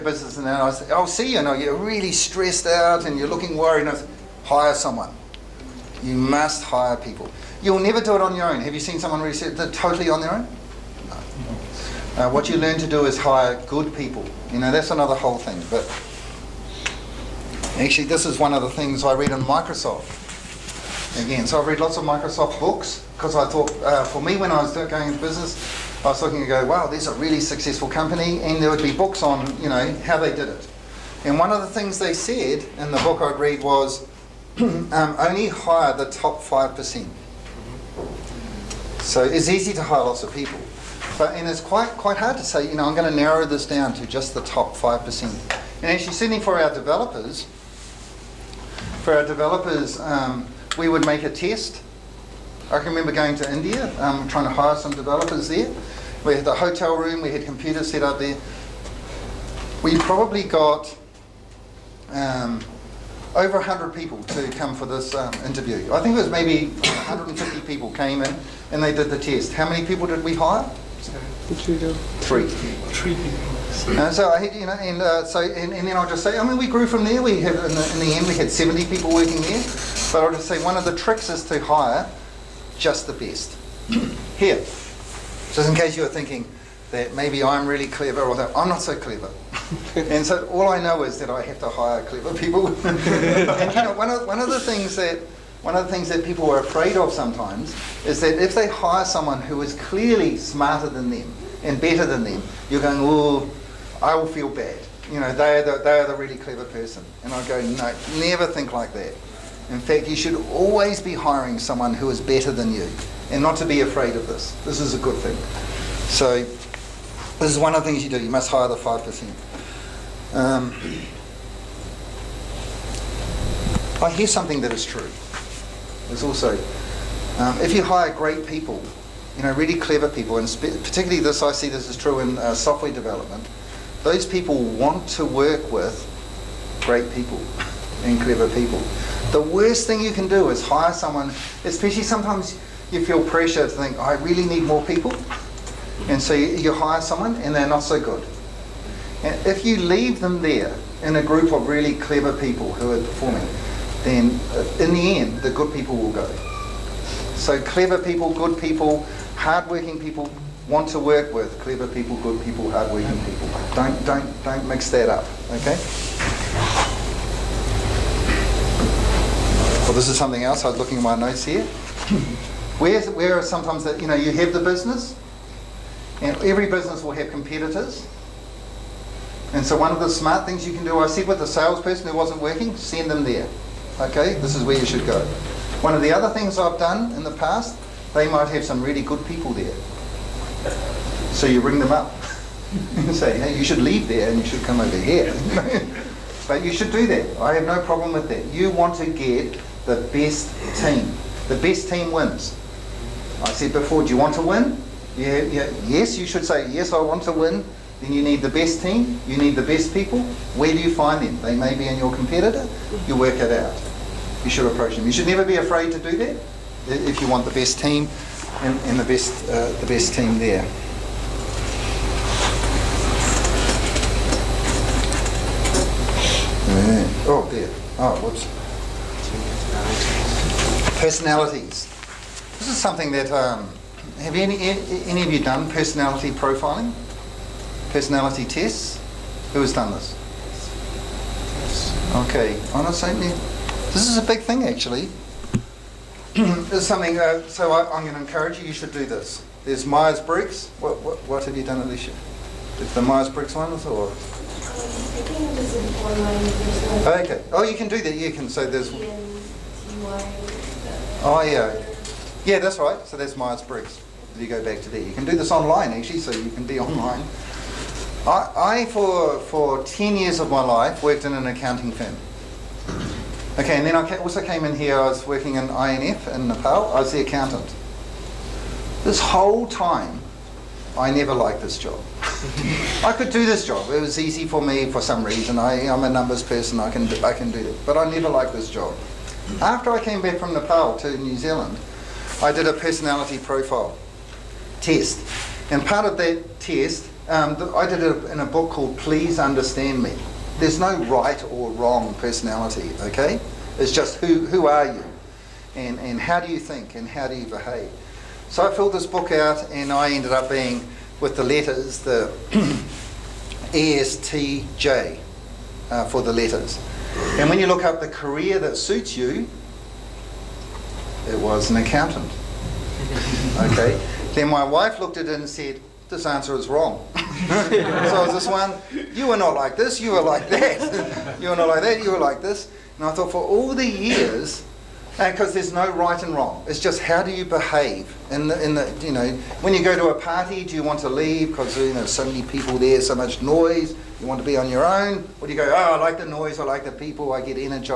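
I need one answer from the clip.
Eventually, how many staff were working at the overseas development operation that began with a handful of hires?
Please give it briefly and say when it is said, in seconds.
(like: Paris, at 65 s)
70, at 78 s.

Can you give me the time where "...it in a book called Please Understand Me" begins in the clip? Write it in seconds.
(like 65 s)
298 s.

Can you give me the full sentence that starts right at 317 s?
And when you look up the career that suits you, it was an accountant.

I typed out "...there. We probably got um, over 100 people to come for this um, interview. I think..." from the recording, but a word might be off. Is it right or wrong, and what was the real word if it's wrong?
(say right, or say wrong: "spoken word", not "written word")
right.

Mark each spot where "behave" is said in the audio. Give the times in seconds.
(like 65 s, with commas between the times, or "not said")
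307 s, 337 s.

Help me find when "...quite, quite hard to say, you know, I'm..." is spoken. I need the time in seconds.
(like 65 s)
41 s.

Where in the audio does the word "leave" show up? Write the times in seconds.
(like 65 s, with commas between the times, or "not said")
149 s, 193 s, 341 s.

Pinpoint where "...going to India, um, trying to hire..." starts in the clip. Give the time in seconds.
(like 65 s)
53 s.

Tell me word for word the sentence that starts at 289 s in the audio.
After I came back from Nepal to New Zealand, I did a personality profile test.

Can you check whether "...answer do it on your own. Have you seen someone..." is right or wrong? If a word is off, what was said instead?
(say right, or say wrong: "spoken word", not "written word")
wrong: "never", not "answer".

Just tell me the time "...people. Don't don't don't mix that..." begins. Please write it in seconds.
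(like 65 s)
163 s.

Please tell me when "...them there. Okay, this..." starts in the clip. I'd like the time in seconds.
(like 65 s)
183 s.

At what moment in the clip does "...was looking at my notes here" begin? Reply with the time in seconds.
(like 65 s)
170 s.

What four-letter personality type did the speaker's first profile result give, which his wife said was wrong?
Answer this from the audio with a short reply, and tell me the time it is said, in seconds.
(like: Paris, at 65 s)
ESTJ, at 313 s.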